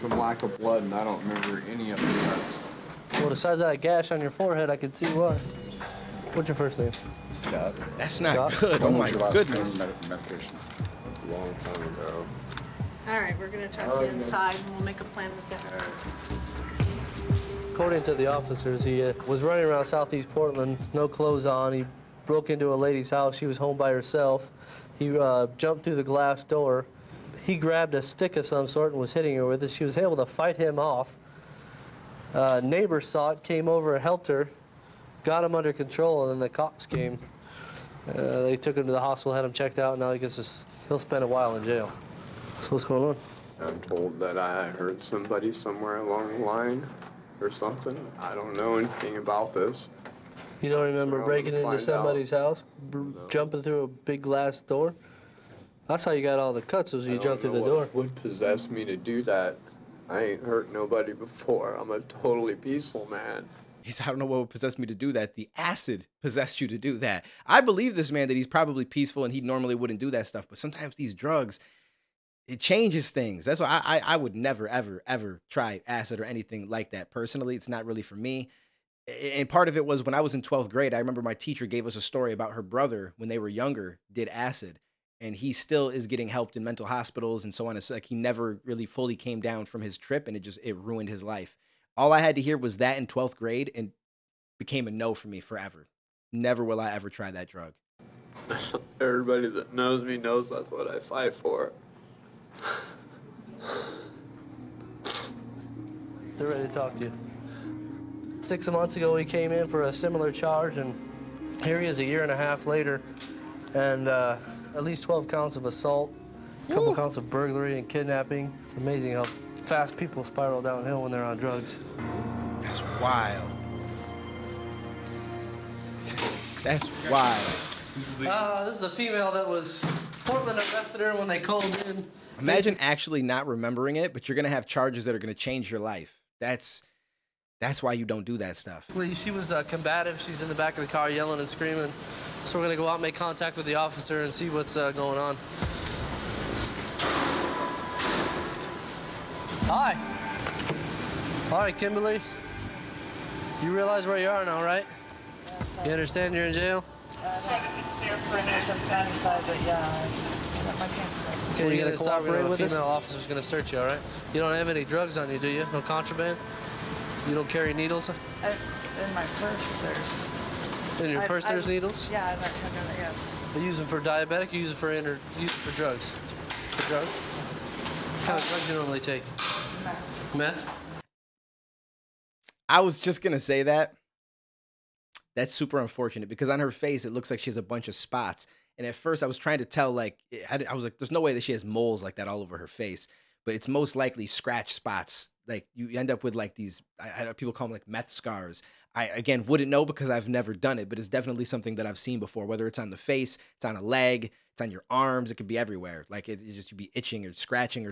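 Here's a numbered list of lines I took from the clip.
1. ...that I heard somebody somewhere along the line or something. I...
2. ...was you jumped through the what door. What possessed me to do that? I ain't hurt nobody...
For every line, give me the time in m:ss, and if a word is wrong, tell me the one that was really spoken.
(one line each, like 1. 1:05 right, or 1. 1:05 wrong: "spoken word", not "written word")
1. 0:44 right
2. 0:56 right.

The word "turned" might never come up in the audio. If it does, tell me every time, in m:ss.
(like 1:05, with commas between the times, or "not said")
not said.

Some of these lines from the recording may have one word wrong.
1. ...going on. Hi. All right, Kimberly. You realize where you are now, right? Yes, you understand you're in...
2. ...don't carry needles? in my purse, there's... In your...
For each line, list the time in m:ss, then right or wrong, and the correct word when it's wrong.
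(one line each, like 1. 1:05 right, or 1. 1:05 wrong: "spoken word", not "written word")
1. 2:24 right
2. 2:47 right.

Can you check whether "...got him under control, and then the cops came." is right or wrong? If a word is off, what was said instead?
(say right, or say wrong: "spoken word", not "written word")
right.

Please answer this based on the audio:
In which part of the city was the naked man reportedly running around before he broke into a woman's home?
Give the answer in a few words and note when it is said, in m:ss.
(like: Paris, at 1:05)
Southeast Portland, at 0:19.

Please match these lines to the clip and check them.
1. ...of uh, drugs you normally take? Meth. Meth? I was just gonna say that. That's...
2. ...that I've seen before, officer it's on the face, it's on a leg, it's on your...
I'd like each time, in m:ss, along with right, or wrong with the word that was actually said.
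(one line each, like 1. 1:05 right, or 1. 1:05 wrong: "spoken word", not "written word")
1. 2:58 right
2. 3:21 wrong: "whether", not "officer".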